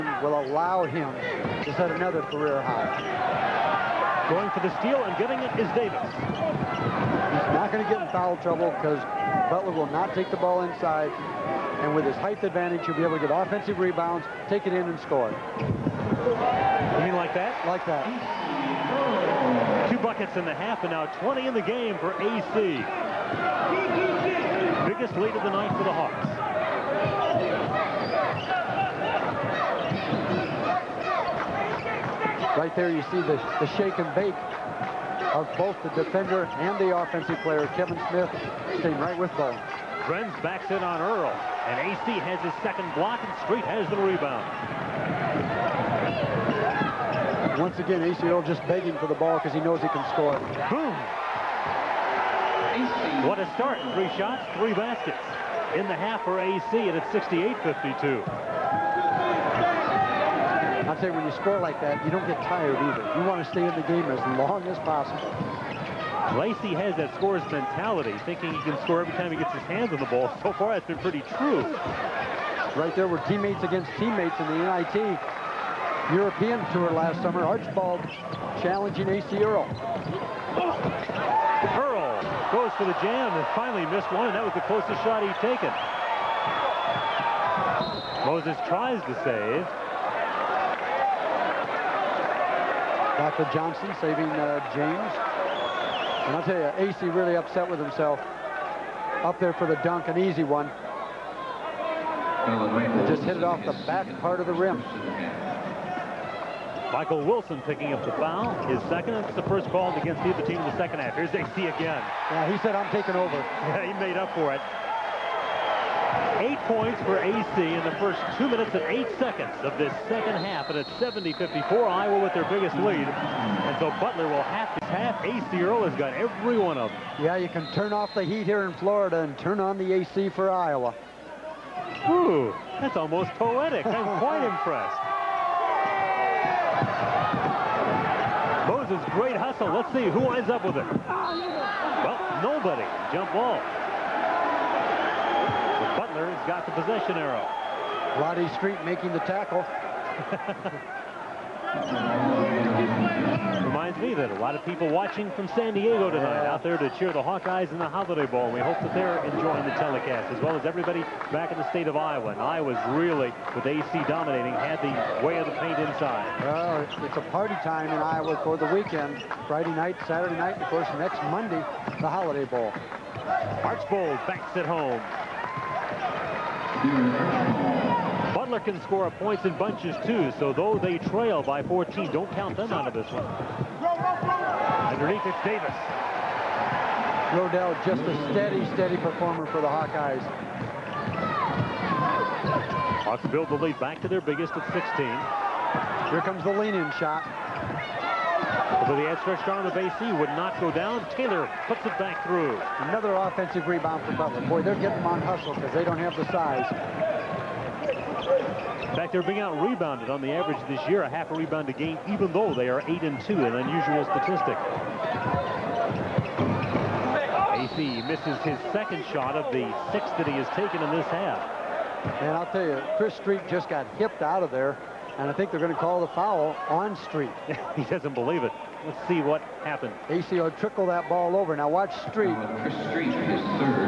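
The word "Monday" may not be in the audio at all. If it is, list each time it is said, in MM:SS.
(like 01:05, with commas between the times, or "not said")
02:51.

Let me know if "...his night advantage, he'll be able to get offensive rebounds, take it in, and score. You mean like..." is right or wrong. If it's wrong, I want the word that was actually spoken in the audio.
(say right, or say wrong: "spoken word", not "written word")
wrong: "height", not "night".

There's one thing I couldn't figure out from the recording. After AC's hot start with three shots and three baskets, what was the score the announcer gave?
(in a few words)
68-52.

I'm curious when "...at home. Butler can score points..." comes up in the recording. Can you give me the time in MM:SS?
02:54.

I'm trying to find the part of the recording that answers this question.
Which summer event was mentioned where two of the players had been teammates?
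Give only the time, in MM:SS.
01:14.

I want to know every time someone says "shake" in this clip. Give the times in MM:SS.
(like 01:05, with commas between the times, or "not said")
00:33.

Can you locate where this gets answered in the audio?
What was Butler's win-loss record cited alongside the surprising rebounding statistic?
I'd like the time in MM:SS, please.
03:32.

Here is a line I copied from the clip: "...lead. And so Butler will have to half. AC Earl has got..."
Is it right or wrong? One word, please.
right.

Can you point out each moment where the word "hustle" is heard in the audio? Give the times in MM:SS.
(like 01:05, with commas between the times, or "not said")
02:19, 03:25.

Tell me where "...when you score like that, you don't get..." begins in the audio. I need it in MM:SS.
01:01.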